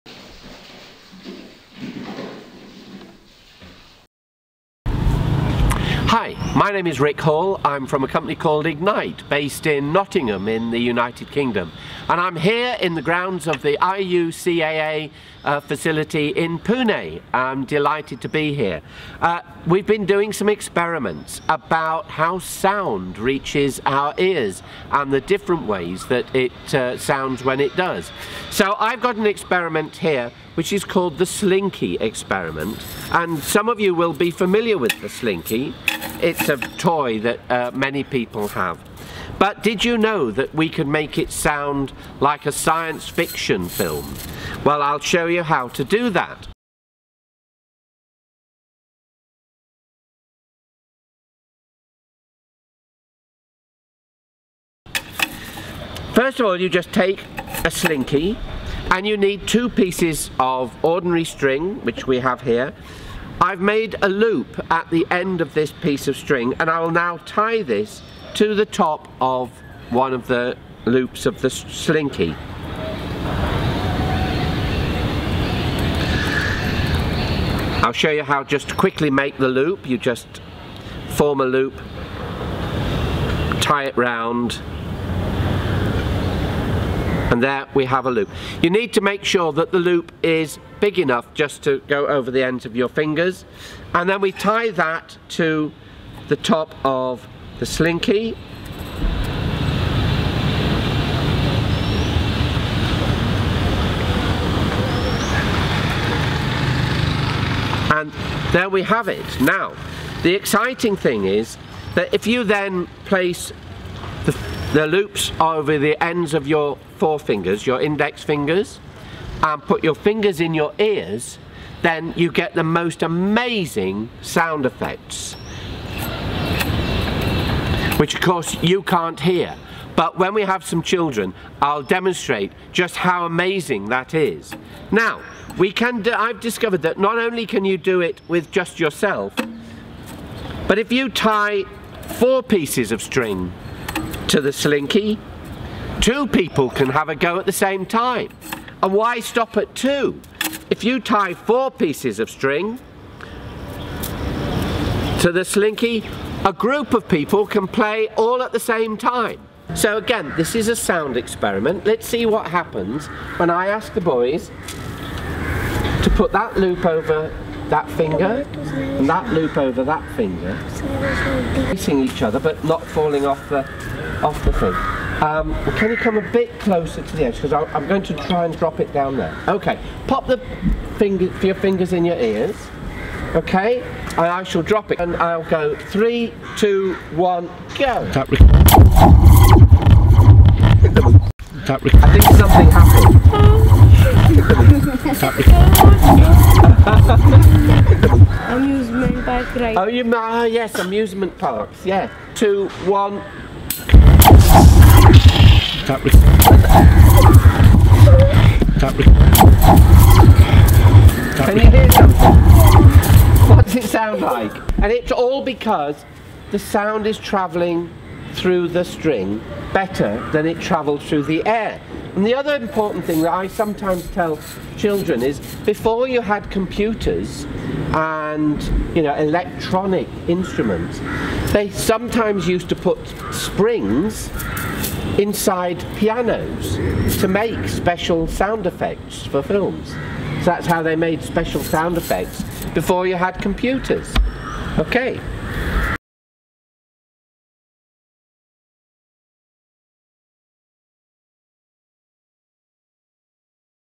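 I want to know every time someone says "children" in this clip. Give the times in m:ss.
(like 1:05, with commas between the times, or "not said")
2:10, 3:44.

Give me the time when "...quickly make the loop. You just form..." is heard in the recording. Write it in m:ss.
1:18.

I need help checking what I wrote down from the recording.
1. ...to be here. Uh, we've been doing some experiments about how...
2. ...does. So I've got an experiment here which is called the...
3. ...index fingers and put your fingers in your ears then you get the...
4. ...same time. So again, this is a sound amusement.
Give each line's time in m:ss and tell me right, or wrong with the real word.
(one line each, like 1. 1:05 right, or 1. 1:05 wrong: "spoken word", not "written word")
1. 0:18 right
2. 0:27 right
3. 1:57 right
4. 2:38 wrong: "experiment", not "amusement".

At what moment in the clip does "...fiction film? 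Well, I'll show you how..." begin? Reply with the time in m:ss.
0:43.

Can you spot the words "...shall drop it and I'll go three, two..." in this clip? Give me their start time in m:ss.
3:04.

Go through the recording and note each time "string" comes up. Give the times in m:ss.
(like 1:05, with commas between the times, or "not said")
1:01, 1:06, 2:23, 2:32, 3:38.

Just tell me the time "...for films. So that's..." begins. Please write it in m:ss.
3:59.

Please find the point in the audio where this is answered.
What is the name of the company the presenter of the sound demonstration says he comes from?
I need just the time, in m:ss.
0:08.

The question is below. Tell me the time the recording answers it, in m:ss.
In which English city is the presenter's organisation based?
0:09.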